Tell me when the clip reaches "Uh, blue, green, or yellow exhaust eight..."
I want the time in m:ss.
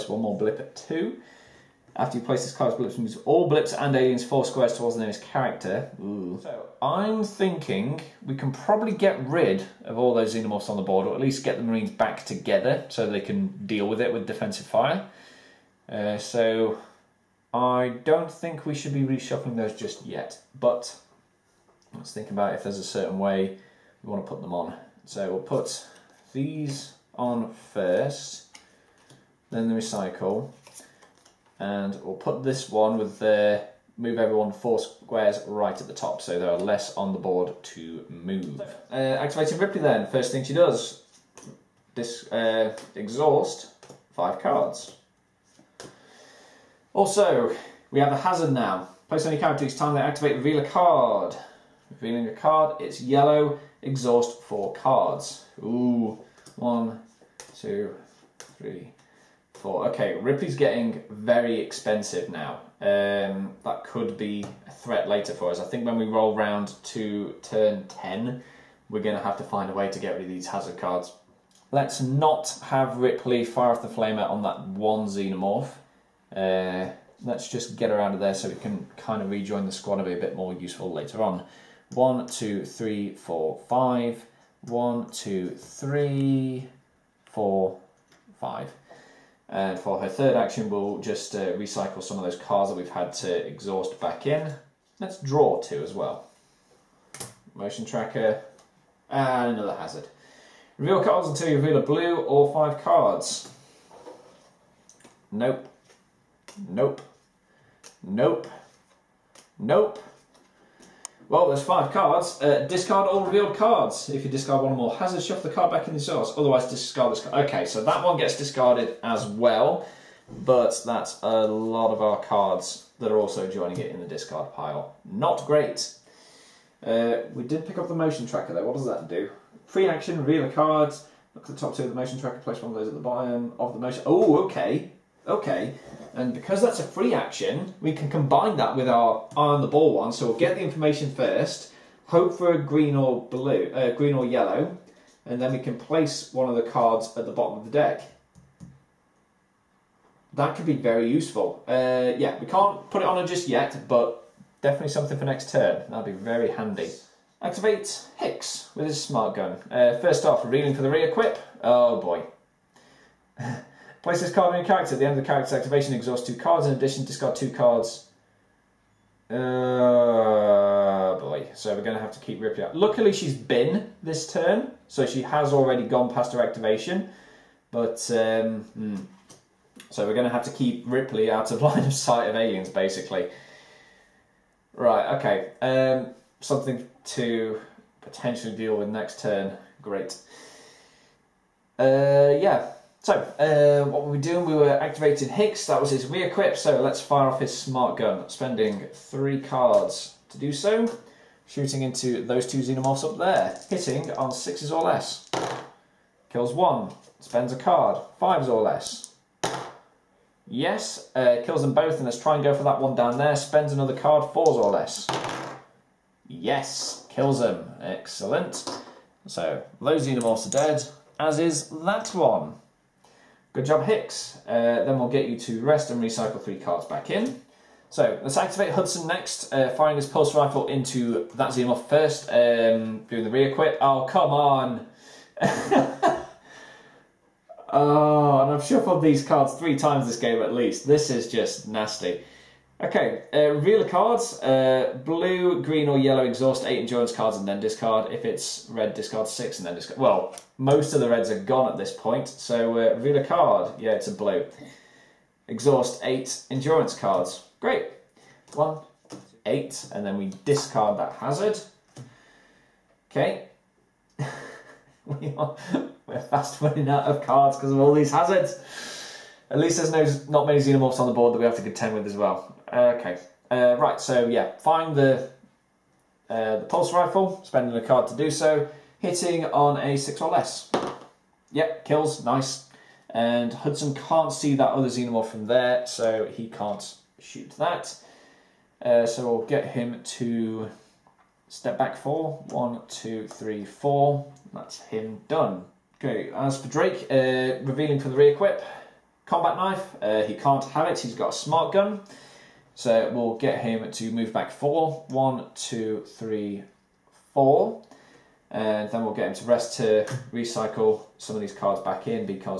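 4:04.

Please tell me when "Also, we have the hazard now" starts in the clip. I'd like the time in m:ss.
0:46.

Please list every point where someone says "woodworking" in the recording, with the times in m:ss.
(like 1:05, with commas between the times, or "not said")
not said.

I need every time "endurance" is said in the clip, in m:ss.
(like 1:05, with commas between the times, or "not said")
4:06, 4:16.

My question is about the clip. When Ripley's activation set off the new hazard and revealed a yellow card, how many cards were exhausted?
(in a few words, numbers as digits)
4.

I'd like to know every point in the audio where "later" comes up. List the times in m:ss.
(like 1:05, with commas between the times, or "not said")
1:05, 1:20.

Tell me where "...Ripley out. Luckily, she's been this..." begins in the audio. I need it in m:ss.
2:52.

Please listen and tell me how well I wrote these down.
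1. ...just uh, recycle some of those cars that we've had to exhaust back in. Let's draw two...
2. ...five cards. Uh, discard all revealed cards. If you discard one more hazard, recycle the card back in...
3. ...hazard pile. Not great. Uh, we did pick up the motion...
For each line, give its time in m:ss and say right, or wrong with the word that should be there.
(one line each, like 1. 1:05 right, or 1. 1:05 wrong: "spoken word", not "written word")
1. 1:30 right
2. 1:51 wrong: "shuffle", not "recycle"
3. 2:04 wrong: "discard", not "hazard".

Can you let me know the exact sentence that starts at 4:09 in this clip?
Well, most of the reds are gone at this point, so uh, reveal a card.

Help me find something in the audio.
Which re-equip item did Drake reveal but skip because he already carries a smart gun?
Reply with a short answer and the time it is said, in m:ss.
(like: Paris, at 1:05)
Combat knife, at 4:59.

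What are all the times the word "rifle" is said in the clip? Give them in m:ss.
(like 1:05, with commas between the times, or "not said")
3:50, 4:36.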